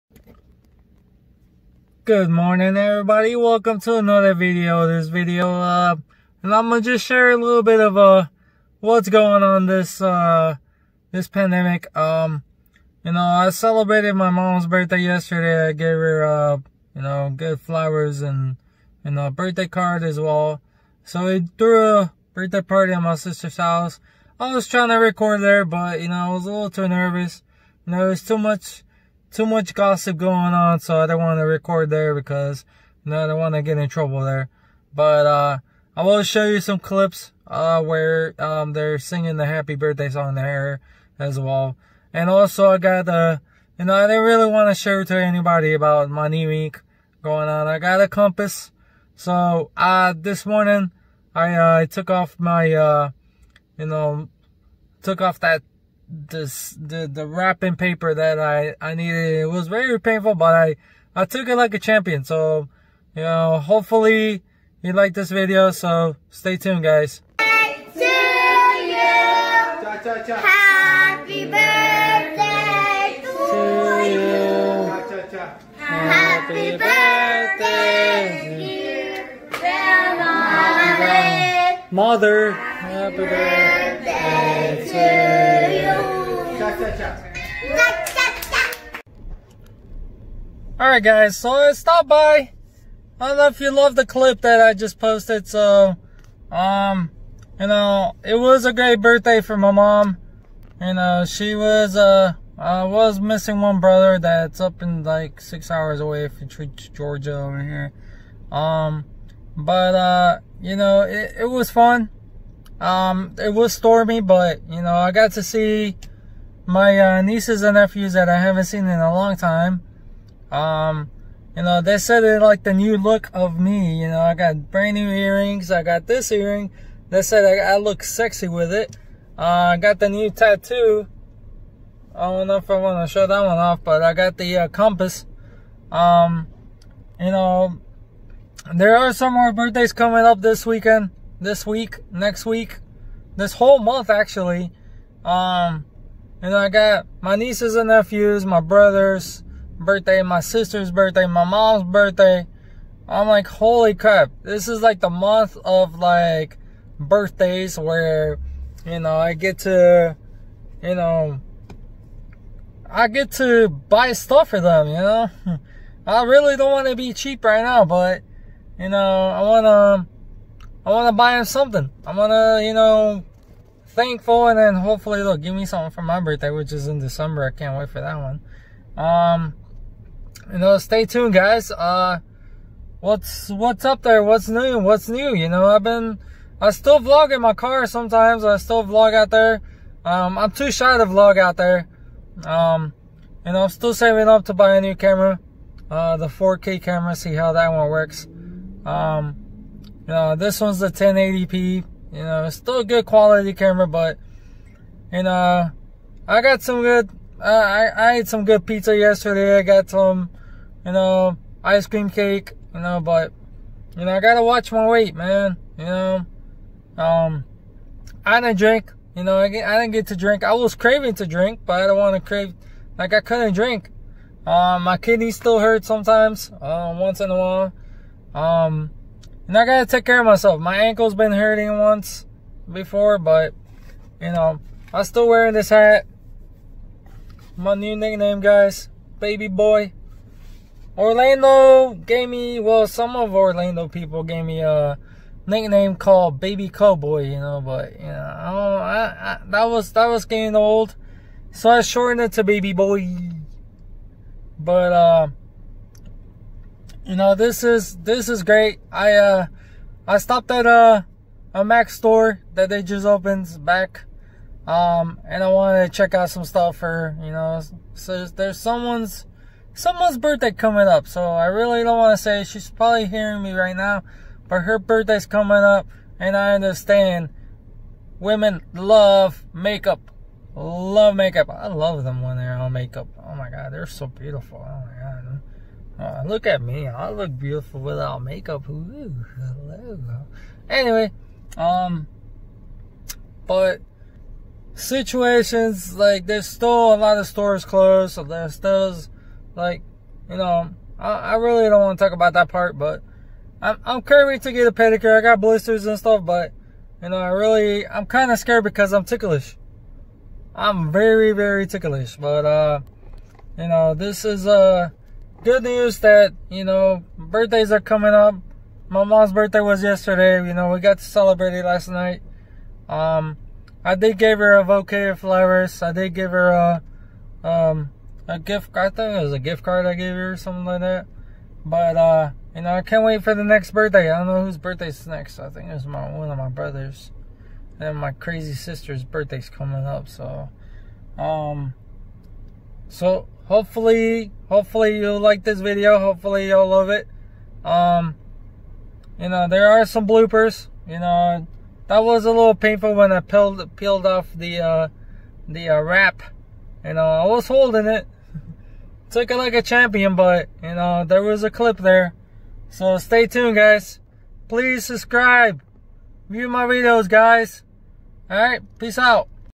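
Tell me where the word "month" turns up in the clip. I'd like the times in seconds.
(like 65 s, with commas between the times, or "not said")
143 s, 155 s.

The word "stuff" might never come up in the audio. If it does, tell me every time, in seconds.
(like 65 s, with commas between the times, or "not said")
164 s, 266 s, 305 s.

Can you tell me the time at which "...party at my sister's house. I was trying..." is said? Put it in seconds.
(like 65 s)
22 s.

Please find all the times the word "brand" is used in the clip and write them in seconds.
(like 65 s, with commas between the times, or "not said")
124 s.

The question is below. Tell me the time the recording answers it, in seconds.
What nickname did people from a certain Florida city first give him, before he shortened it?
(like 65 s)
246 s.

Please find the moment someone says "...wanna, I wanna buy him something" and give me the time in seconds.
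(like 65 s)
169 s.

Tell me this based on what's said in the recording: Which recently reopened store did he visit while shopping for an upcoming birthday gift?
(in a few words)
Mac.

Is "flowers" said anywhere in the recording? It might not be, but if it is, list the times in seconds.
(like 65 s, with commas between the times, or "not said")
17 s, 325 s.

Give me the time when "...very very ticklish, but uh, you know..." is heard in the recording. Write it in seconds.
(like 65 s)
310 s.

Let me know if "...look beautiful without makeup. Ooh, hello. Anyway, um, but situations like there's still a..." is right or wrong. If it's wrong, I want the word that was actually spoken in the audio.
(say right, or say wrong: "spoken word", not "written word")
right.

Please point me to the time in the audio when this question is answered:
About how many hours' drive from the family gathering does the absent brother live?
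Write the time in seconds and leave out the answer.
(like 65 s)
105 s.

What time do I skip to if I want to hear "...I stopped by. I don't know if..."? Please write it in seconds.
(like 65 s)
91 s.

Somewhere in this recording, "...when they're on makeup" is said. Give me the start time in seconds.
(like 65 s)
282 s.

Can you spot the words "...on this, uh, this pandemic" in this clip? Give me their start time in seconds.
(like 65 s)
9 s.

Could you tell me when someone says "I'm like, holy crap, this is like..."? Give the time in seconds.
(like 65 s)
153 s.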